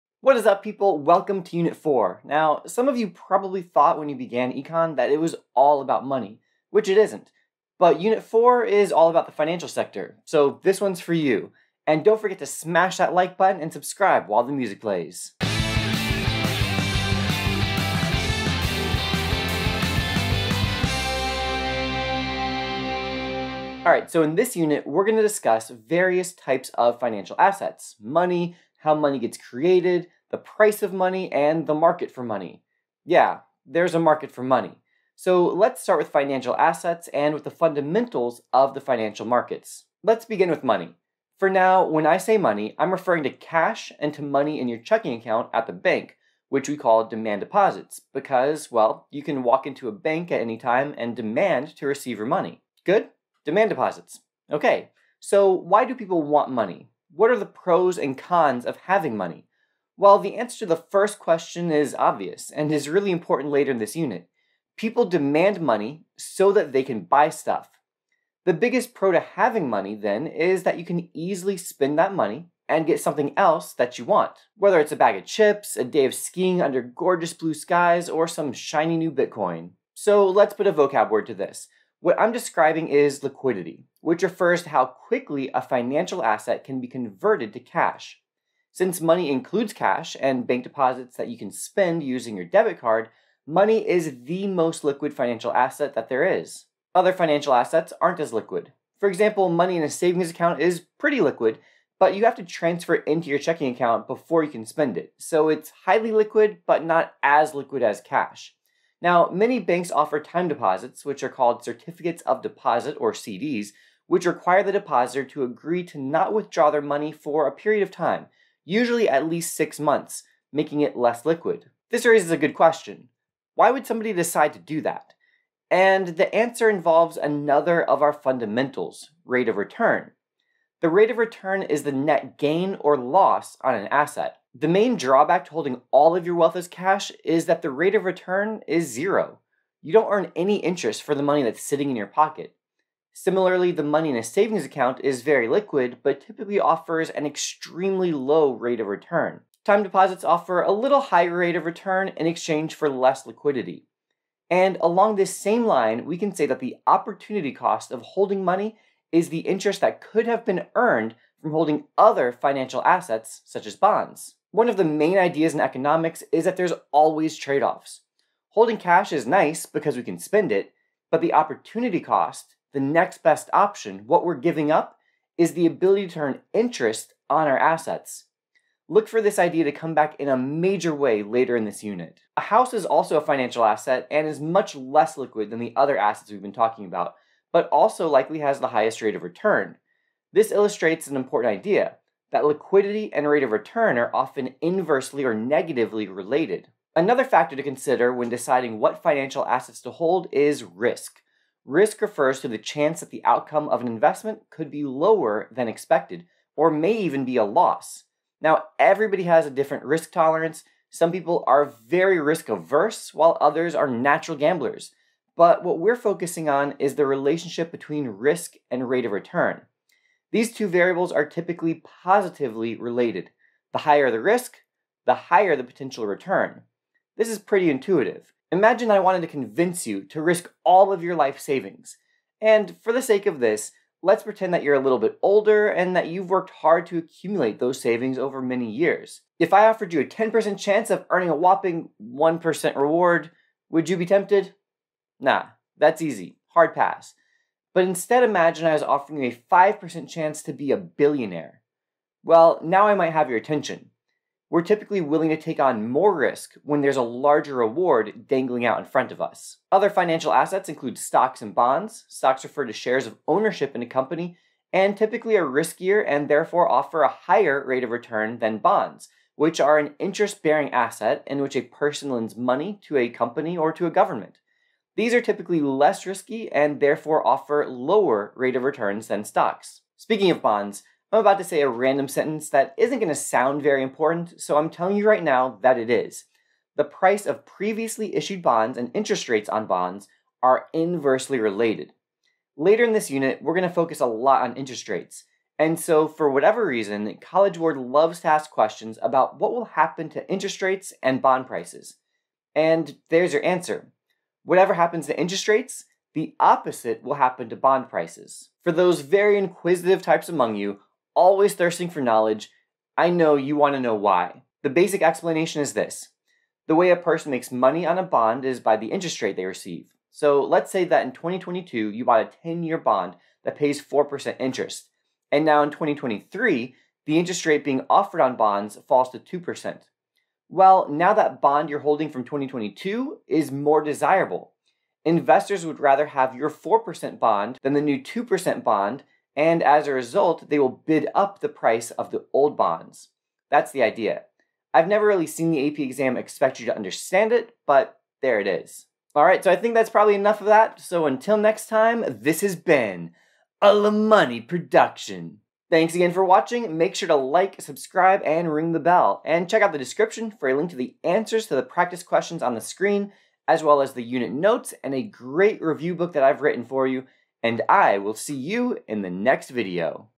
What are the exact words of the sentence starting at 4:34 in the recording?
These are typically less risky and therefore offer lower rate of returns than stocks.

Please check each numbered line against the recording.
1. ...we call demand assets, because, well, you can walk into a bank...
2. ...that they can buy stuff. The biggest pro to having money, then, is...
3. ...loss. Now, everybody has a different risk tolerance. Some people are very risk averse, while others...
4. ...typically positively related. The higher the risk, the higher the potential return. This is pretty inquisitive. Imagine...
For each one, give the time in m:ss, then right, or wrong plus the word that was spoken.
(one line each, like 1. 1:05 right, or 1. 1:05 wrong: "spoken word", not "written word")
1. 0:46 wrong: "deposits", not "assets"
2. 1:06 right
3. 3:27 right
4. 3:41 wrong: "intuitive", not "inquisitive".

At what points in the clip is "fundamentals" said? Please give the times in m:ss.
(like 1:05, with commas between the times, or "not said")
0:37, 2:08.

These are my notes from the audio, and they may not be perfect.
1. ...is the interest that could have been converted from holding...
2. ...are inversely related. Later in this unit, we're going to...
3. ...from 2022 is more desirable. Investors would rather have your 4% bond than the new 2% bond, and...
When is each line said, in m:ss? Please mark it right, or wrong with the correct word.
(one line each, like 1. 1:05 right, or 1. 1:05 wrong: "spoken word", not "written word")
1. 2:39 wrong: "earned", not "converted"
2. 4:50 right
3. 5:32 right.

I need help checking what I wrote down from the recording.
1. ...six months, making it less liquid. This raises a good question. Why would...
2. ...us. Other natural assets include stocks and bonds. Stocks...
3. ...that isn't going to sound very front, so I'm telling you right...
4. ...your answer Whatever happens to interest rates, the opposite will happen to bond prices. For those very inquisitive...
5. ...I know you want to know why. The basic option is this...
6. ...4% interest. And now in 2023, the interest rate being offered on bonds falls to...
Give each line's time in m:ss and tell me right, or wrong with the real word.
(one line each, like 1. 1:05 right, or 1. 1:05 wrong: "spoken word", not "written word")
1. 1:59 right
2. 4:19 wrong: "financial", not "natural"
3. 4:42 wrong: "important", not "front"
4. 5:03 right
5. 5:12 wrong: "explanation", not "option"
6. 5:23 right.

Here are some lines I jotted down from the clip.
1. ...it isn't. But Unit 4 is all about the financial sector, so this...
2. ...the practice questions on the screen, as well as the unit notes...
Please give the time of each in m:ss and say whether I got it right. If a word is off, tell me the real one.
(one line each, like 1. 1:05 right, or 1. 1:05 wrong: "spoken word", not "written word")
1. 0:06 right
2. 6:01 right.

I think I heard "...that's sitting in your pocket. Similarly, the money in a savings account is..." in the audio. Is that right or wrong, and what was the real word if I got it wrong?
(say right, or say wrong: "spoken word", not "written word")
right.